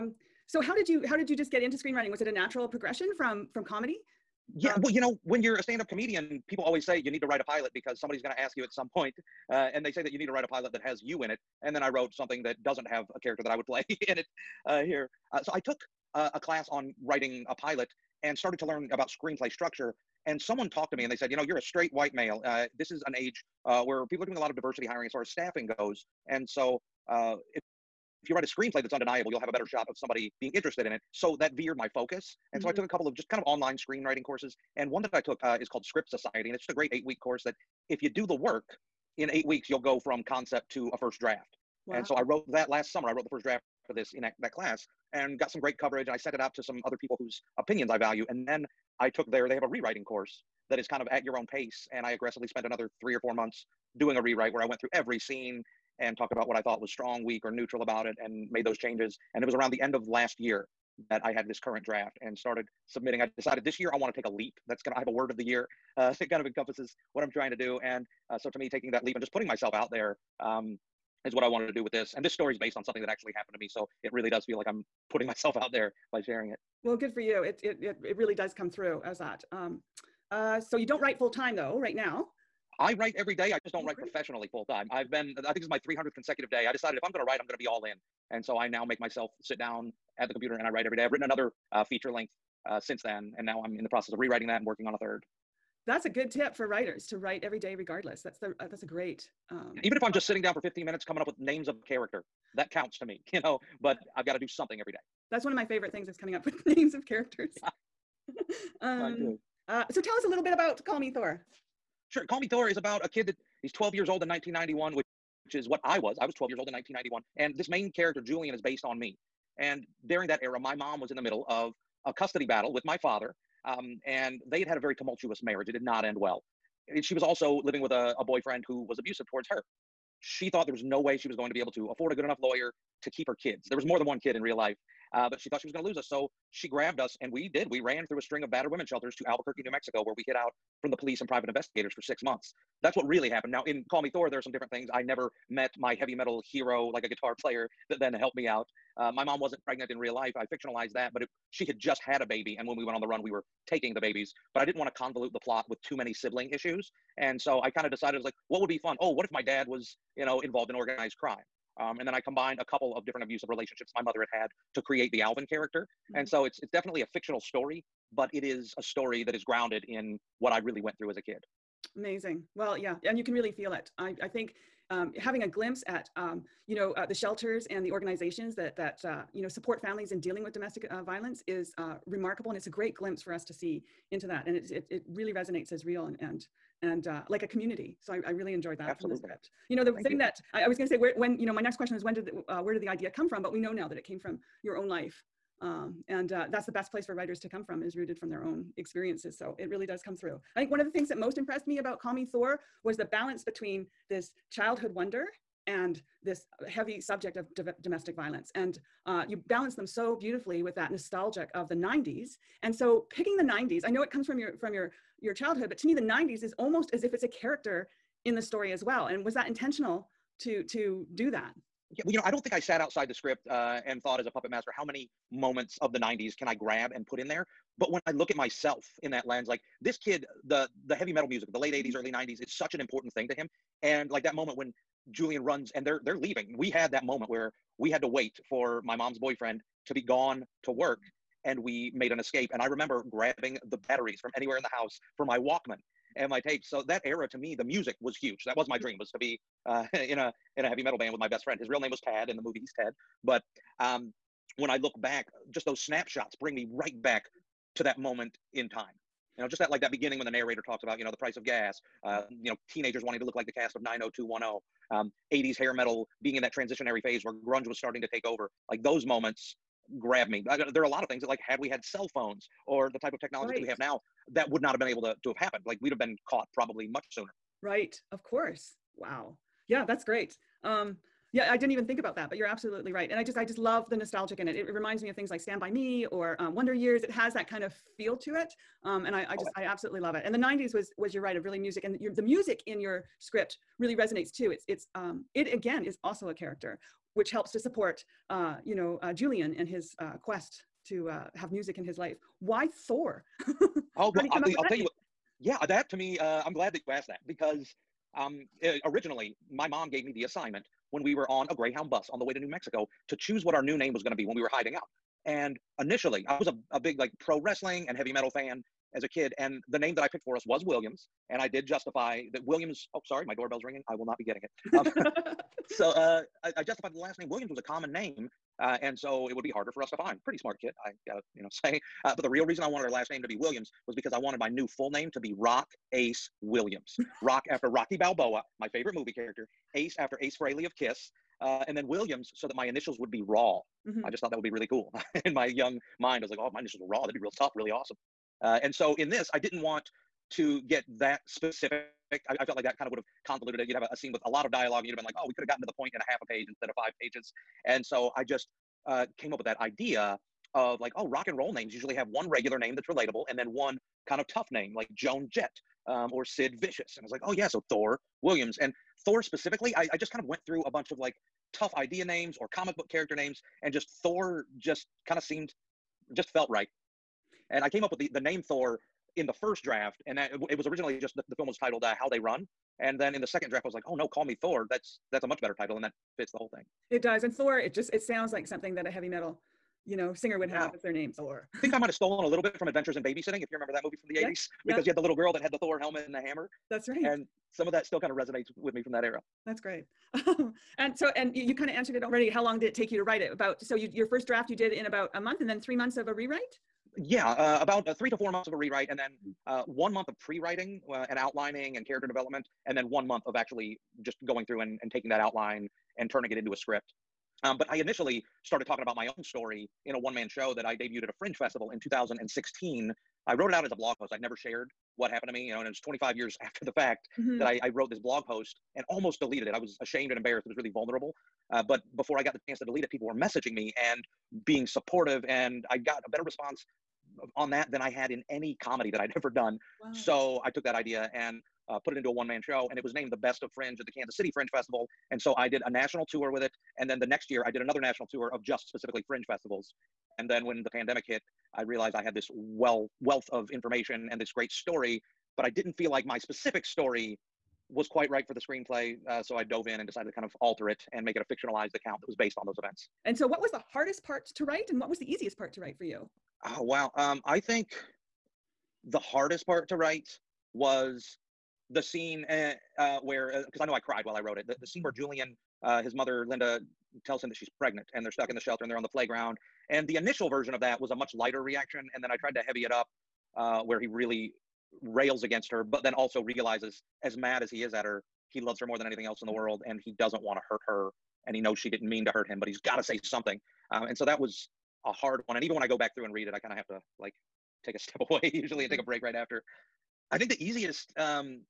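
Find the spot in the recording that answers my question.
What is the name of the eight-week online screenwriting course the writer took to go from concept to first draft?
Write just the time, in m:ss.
0:35.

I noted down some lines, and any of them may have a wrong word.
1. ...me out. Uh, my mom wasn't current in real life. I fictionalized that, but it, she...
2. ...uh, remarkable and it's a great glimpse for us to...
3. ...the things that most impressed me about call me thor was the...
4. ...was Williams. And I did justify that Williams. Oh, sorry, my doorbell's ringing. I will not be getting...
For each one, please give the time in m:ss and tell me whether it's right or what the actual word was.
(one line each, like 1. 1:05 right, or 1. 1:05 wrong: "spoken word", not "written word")
1. 2:28 wrong: "pregnant", not "current"
2. 3:01 right
3. 3:20 right
4. 5:20 right.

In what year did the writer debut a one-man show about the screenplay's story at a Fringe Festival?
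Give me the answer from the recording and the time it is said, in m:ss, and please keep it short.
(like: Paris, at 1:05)
2016, at 7:01.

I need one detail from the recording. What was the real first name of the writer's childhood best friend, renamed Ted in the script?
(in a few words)
Tad.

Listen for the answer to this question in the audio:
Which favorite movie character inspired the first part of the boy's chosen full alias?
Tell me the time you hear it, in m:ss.
5:37.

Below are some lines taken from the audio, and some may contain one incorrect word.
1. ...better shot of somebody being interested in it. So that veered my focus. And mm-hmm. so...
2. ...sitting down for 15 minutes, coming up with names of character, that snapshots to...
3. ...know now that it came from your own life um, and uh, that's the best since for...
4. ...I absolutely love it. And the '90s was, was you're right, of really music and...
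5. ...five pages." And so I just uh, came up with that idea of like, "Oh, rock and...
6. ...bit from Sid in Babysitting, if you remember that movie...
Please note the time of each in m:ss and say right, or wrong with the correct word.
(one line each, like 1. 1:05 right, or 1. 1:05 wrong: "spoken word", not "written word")
1. 0:29 right
2. 1:40 wrong: "counts", not "snapshots"
3. 3:13 wrong: "place", not "since"
4. 4:49 right
5. 5:56 right
6. 6:32 wrong: "Adventures", not "Sid".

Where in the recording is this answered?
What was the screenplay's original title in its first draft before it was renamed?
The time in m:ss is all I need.
6:21.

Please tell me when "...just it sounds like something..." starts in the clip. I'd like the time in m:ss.
6:27.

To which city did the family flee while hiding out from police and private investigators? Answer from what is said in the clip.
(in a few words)
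Albuquerque, New Mexico.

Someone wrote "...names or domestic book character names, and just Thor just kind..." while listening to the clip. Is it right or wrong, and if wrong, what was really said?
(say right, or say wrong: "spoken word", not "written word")
wrong: "comic", not "domestic".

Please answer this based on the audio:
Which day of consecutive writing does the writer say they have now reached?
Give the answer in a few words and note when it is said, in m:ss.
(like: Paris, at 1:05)
300th, at 1:25.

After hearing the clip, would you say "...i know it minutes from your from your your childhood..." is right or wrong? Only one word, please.
wrong.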